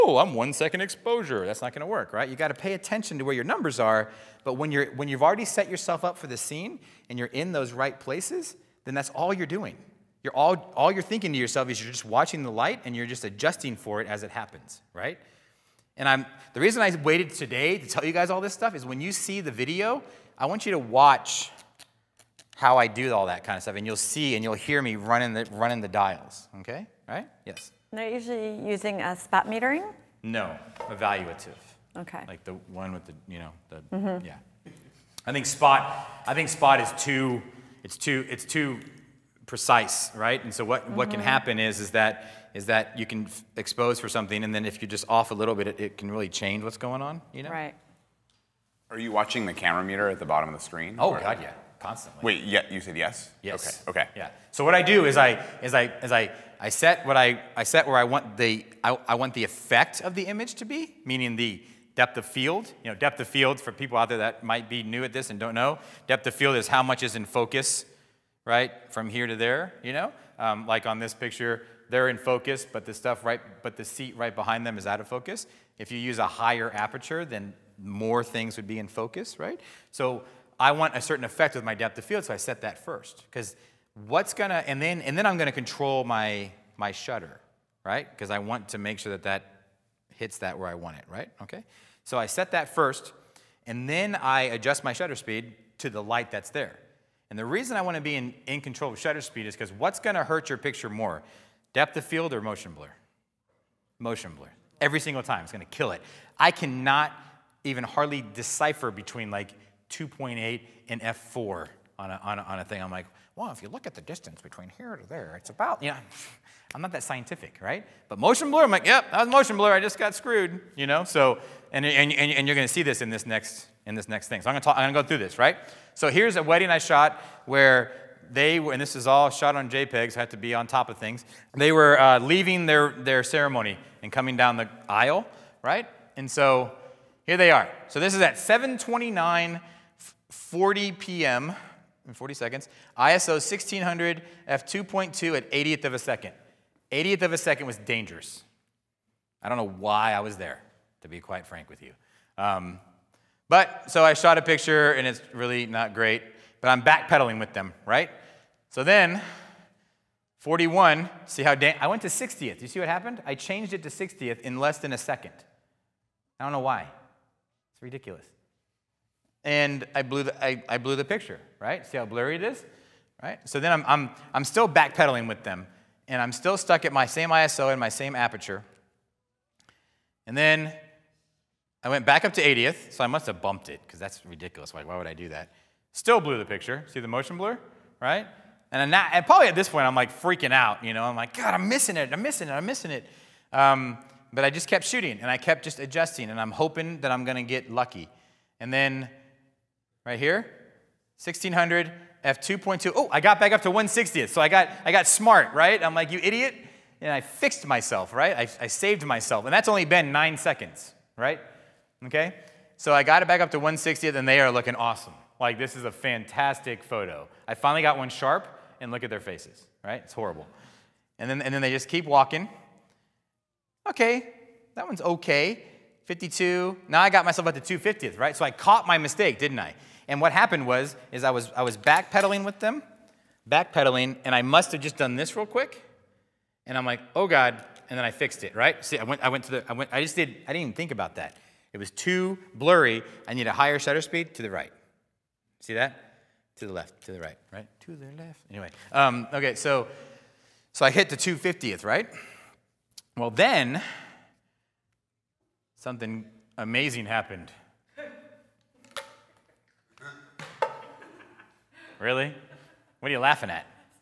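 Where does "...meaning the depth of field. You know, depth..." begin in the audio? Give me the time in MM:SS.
01:01.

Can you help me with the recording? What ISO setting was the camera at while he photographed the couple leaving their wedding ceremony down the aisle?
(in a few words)
1600.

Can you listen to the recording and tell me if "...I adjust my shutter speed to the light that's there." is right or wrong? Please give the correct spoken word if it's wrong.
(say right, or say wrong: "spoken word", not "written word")
right.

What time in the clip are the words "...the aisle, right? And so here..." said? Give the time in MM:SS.
02:14.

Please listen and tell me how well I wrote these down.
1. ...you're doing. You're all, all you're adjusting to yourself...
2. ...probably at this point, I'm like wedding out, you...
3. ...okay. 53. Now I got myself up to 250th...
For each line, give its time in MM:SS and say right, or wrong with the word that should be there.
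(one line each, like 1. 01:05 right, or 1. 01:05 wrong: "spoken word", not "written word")
1. 00:09 wrong: "thinking", not "adjusting"
2. 03:09 wrong: "freaking", not "wedding"
3. 03:45 wrong: "52", not "53".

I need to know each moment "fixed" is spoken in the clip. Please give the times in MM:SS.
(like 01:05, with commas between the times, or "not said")
03:27, 03:58.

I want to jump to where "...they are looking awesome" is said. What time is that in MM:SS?
03:34.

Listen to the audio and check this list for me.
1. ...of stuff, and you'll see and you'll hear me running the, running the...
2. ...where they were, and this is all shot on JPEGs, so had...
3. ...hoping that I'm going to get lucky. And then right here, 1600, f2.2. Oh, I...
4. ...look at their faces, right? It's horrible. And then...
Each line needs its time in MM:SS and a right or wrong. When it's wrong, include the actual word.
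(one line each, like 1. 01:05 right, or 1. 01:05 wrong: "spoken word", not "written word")
1. 00:23 right
2. 02:07 right
3. 03:16 right
4. 03:38 right.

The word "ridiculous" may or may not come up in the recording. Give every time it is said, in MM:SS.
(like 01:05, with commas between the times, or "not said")
02:47, 03:04.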